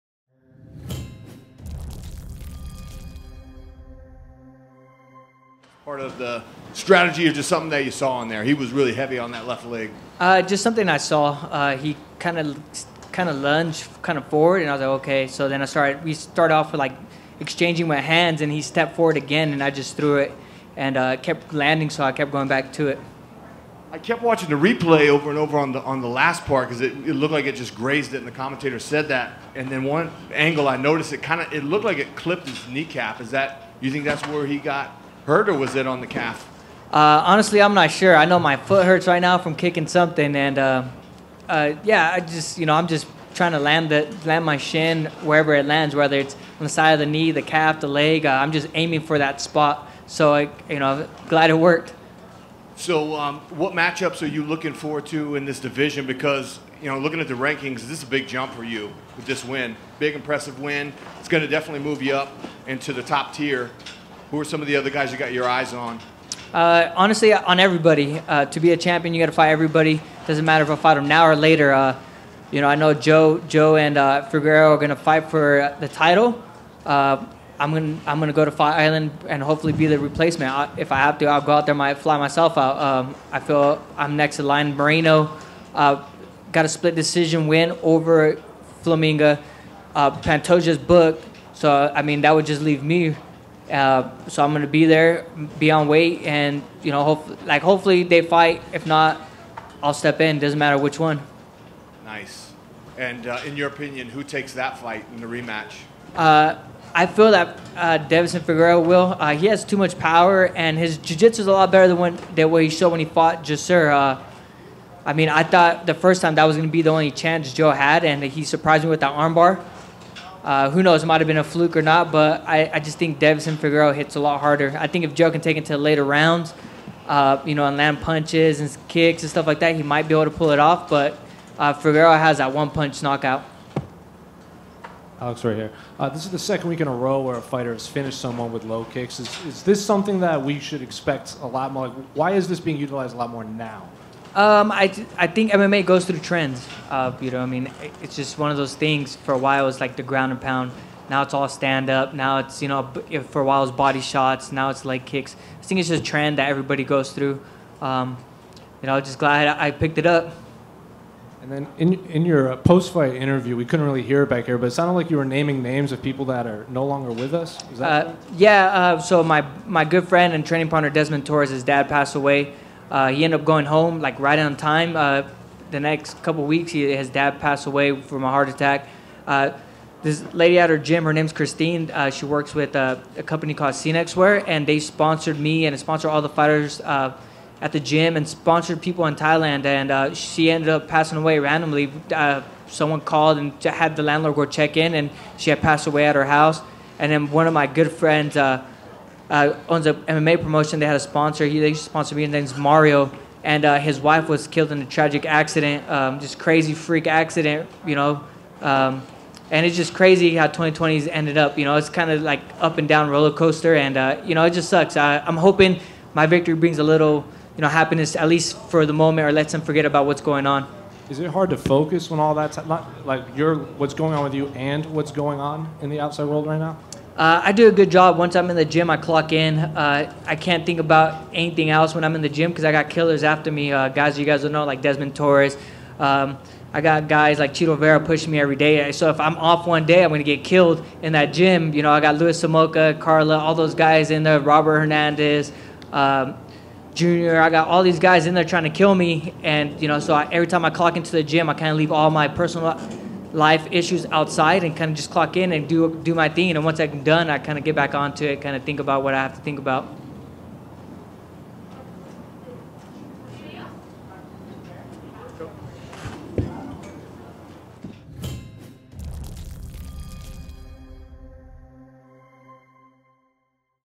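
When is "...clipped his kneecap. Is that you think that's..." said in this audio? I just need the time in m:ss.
0:32.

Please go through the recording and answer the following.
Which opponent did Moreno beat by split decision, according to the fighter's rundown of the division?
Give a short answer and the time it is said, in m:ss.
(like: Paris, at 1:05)
Formiga, at 1:28.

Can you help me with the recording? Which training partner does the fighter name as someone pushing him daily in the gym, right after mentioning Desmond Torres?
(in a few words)
Chito Vera.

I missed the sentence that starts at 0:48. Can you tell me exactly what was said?
Uh, I'm just aiming for that spot.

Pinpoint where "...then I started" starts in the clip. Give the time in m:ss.
0:15.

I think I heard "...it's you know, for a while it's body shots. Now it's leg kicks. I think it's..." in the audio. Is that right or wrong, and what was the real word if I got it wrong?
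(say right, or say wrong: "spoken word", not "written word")
right.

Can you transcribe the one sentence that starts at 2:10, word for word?
But uh, Figueroa has that one punch knockout.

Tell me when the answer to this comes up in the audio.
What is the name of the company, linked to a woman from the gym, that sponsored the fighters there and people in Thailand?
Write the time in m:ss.
3:03.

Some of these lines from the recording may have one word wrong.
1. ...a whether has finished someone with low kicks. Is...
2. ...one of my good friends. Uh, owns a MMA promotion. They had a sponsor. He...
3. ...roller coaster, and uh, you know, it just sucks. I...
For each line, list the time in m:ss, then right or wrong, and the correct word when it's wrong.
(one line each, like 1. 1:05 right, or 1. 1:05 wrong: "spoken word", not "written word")
1. 2:17 wrong: "fighter", not "whether"
2. 3:17 right
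3. 3:33 right.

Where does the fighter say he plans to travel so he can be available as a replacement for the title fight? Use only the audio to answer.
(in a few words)
Fight Island.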